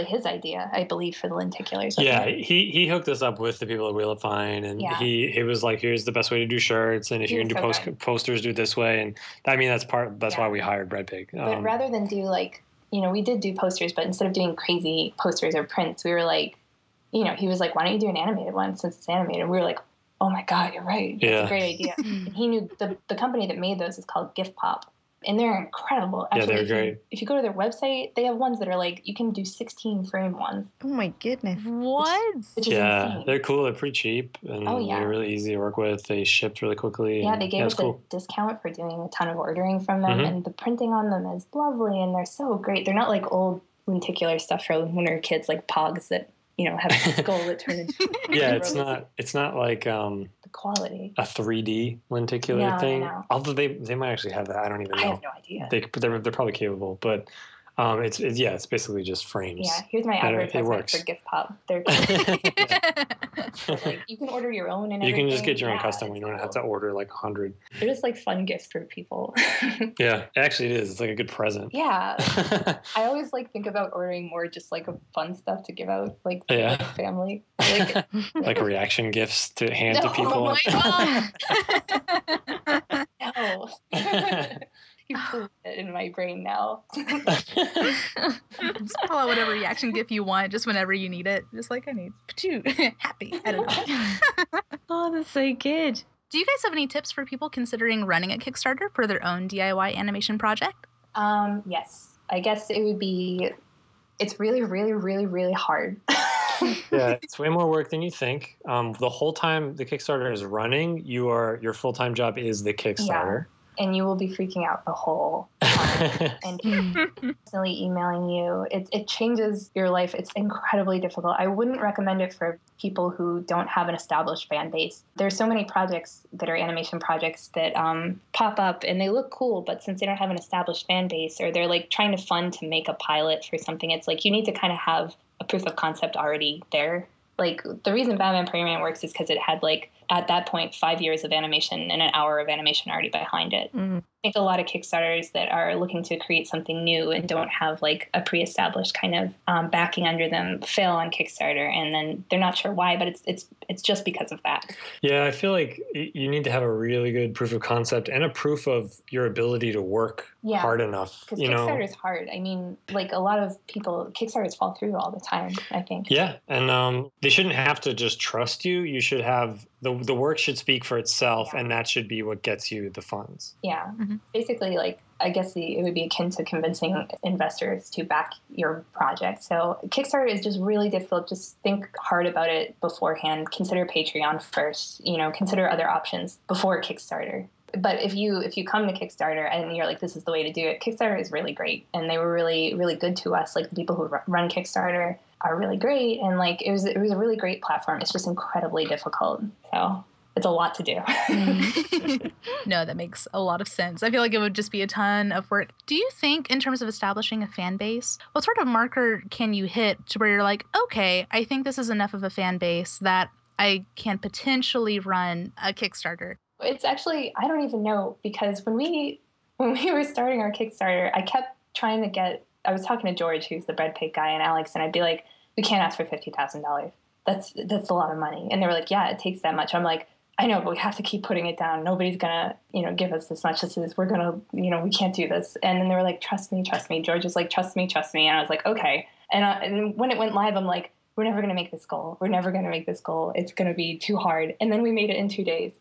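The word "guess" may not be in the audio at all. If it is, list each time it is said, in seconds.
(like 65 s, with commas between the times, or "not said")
102 s, 175 s.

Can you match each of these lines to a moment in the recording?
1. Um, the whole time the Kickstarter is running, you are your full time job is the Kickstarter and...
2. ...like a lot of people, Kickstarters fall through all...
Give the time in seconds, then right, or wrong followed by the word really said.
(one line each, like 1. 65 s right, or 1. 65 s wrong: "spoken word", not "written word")
1. 108 s right
2. 162 s right.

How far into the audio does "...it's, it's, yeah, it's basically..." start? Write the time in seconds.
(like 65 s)
58 s.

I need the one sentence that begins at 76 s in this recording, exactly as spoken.
family, like, like reaction gifts to hand no, to people.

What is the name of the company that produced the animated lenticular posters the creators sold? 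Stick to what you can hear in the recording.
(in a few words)
Gifpop.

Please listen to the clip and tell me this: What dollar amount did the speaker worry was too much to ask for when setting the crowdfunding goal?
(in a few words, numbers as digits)
$50,000.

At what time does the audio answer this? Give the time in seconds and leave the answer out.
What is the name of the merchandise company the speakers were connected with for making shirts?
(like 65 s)
3 s.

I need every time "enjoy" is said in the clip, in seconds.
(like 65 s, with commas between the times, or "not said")
not said.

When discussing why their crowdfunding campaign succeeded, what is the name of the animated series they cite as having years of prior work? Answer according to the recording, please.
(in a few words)
Baman Piderman.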